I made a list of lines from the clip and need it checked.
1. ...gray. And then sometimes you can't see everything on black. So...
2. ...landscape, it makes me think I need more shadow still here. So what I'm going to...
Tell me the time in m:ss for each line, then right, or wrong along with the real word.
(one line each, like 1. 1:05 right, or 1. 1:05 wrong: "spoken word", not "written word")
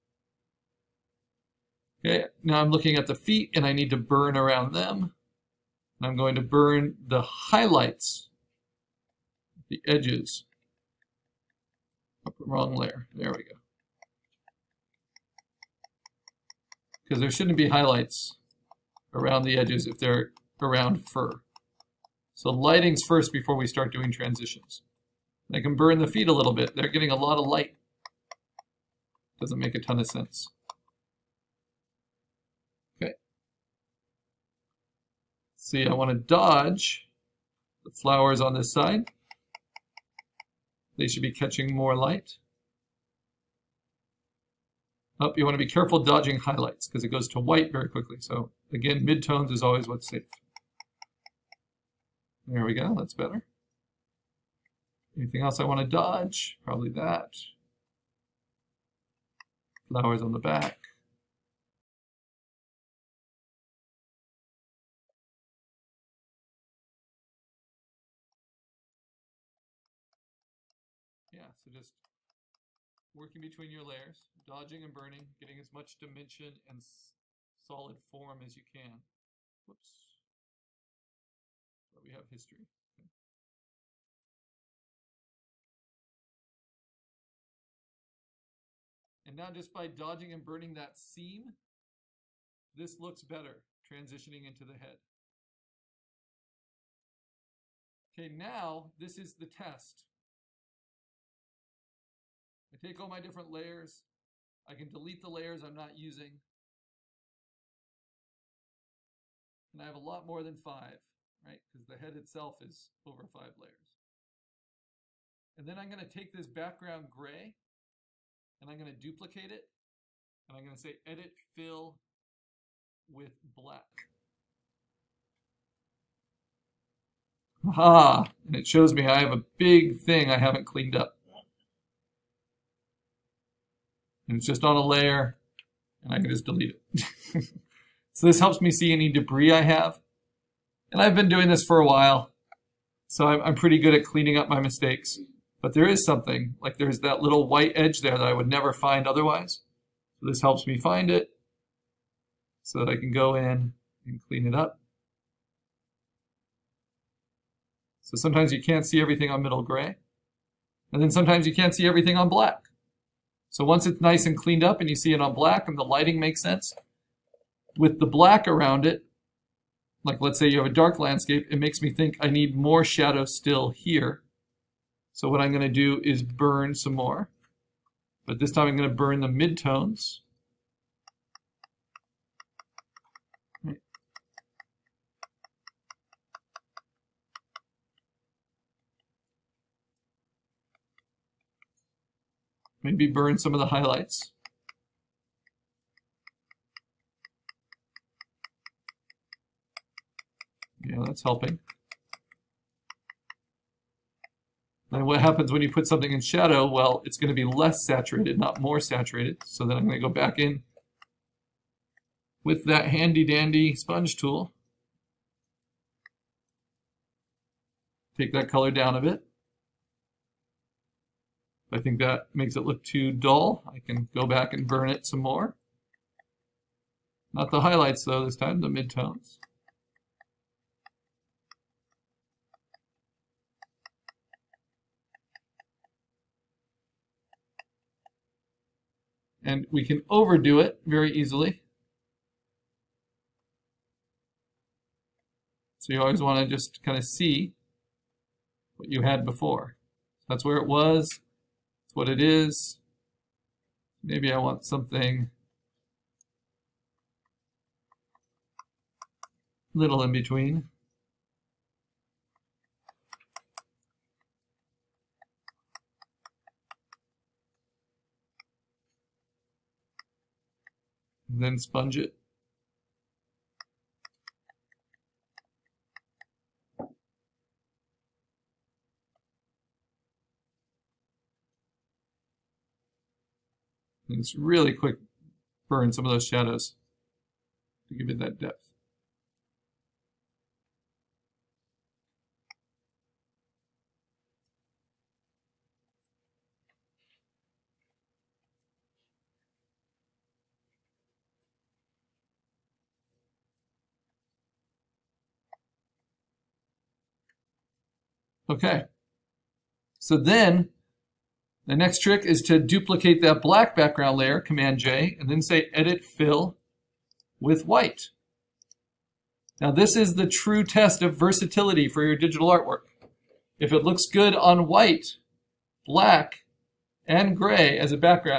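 1. 2:39 right
2. 2:50 right.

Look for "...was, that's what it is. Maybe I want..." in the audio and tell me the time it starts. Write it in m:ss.
4:10.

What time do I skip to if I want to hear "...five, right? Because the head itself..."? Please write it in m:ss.
1:50.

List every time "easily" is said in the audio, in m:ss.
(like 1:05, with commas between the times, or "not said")
4:01.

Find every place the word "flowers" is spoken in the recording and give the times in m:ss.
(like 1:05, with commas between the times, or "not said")
0:37, 0:59.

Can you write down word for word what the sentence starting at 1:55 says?
And then I'm going to take this background gray and I'm going to duplicate it.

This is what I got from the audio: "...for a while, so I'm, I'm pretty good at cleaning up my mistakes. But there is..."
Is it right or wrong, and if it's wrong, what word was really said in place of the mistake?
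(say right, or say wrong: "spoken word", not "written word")
right.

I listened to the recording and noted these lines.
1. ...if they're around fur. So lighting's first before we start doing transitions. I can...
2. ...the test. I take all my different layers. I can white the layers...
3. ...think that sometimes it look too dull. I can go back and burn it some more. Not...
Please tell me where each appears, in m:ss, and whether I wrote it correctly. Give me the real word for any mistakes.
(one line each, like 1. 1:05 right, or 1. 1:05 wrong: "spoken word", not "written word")
1. 0:19 right
2. 1:39 wrong: "delete", not "white"
3. 3:41 wrong: "makes", not "sometimes".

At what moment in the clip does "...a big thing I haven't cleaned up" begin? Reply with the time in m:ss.
2:09.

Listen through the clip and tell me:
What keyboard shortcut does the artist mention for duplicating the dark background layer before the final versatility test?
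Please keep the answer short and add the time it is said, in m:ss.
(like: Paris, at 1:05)
Command J, at 5:14.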